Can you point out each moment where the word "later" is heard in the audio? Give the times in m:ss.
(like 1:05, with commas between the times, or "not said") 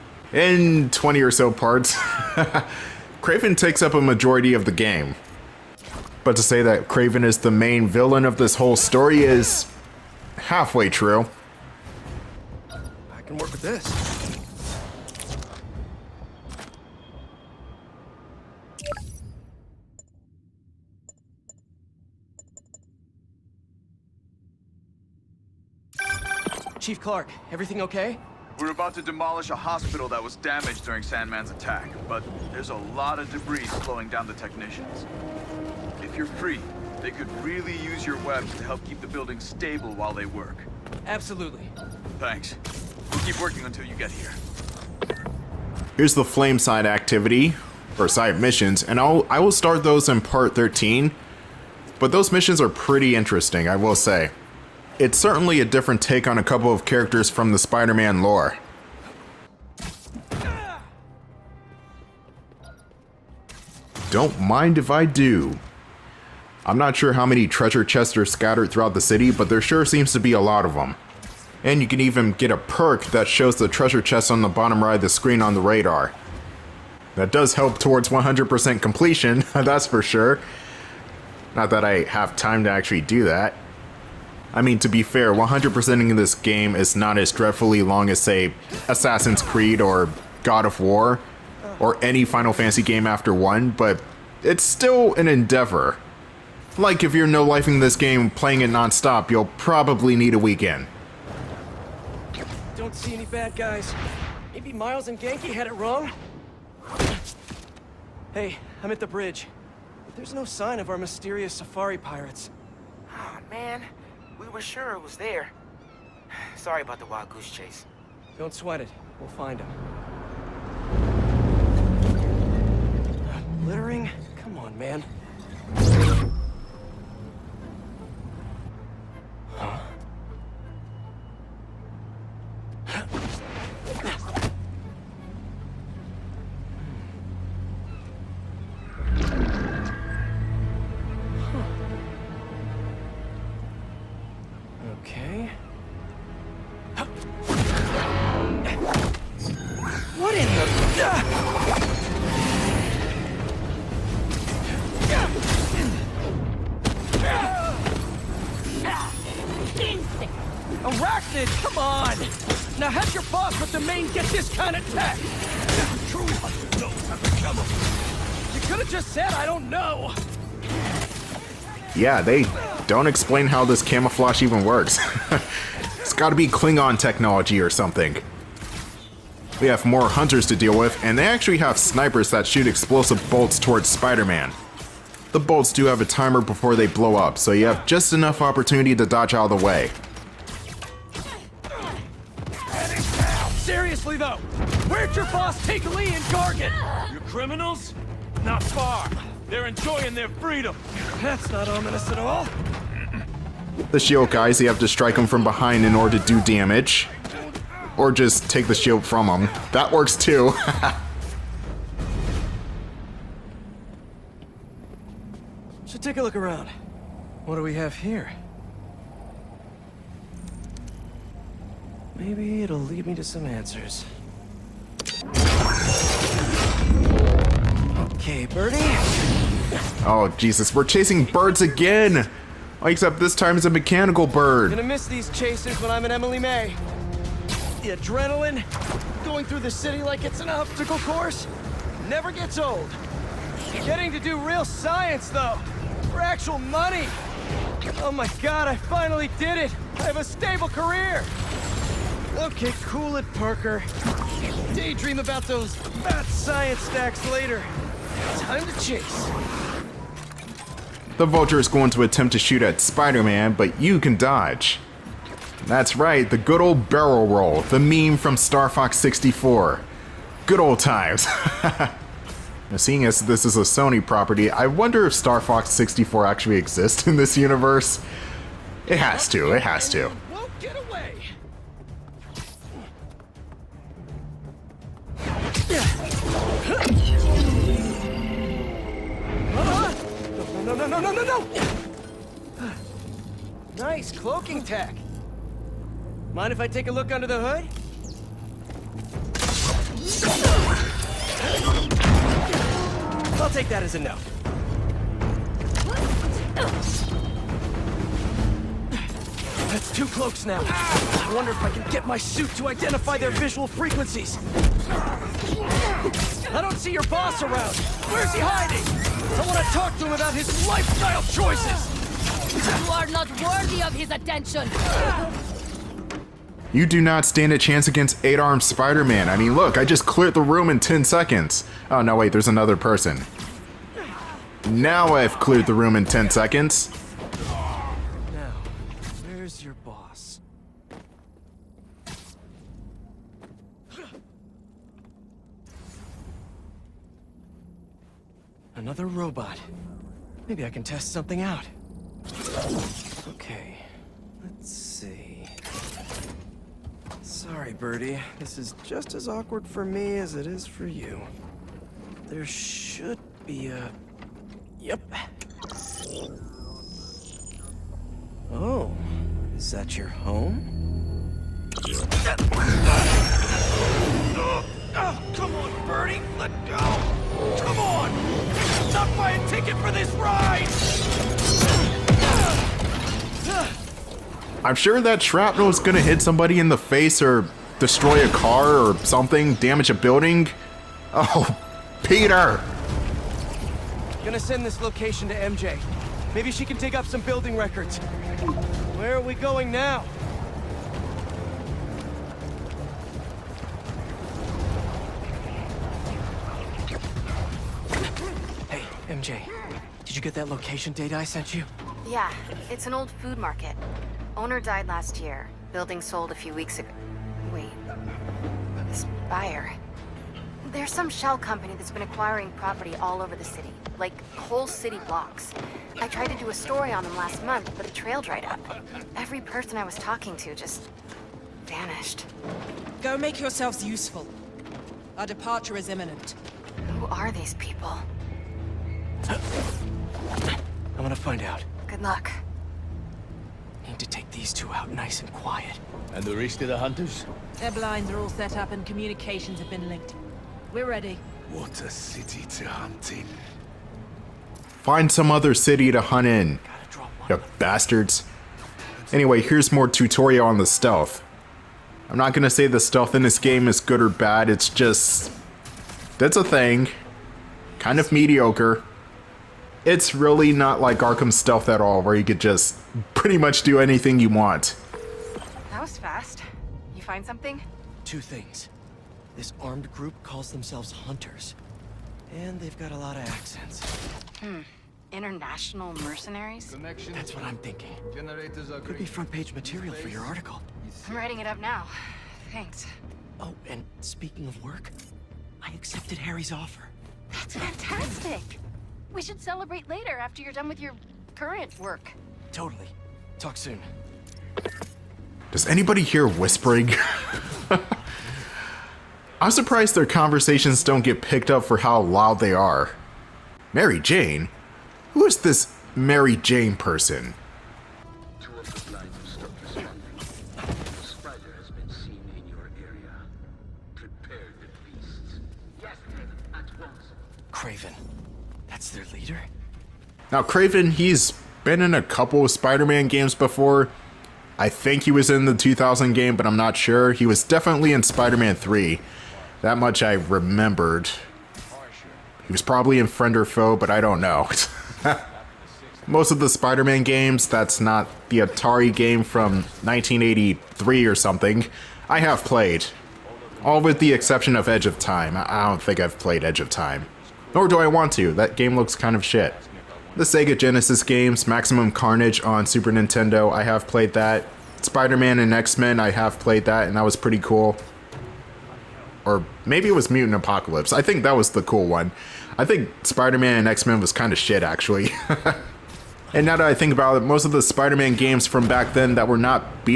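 4:17, 8:19.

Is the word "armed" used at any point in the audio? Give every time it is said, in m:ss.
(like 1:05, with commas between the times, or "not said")
5:28, 7:59.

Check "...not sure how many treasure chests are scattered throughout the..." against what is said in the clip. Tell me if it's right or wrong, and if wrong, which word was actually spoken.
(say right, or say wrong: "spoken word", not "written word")
right.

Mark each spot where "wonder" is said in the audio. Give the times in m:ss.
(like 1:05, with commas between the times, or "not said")
4:34, 5:11.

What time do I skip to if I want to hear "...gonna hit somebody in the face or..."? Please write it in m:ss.
6:25.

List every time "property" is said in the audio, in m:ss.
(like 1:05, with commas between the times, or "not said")
4:34, 7:02.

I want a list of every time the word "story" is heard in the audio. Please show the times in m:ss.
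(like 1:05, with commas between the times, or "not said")
0:08, 7:06.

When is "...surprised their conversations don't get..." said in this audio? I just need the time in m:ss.
8:29.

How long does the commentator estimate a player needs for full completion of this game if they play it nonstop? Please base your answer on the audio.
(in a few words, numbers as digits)
A weekend.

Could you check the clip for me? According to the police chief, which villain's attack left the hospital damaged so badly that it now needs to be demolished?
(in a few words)
Sandman.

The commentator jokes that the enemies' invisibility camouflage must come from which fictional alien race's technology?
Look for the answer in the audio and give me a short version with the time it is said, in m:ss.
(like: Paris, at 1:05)
Klingon, at 2:56.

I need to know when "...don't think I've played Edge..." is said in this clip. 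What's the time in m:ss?
9:15.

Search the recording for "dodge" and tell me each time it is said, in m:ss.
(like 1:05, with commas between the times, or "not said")
3:09, 4:24.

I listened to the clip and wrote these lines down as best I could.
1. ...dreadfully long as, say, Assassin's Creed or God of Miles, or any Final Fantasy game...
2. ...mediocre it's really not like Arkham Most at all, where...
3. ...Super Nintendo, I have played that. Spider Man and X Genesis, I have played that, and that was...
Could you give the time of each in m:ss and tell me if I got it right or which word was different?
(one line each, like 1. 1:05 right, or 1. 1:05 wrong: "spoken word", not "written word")
1. 1:27 wrong: "War", not "Miles"
2. 7:48 wrong: "Stealth", not "Most"
3. 9:22 wrong: "Men", not "Genesis".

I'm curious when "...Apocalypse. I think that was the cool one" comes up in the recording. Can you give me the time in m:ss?
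9:30.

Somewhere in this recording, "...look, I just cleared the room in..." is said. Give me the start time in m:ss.
5:29.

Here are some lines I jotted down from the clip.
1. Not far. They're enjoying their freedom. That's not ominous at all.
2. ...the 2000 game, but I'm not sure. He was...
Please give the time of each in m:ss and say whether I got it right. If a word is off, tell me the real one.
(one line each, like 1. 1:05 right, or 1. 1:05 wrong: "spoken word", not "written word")
1. 3:18 right
2. 8:55 right.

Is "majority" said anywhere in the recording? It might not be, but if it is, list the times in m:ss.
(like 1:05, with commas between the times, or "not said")
0:04.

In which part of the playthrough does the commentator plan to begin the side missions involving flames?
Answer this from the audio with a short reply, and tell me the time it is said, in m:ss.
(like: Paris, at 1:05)
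Part 13, at 0:50.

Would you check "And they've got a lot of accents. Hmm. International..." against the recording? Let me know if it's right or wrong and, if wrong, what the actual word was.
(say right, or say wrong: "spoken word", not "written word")
right.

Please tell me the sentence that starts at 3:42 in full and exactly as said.
Maybe it'll lead me to some answers.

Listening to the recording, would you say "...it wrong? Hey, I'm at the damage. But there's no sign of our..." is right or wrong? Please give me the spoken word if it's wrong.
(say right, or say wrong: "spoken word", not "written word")
wrong: "bridge", not "damage".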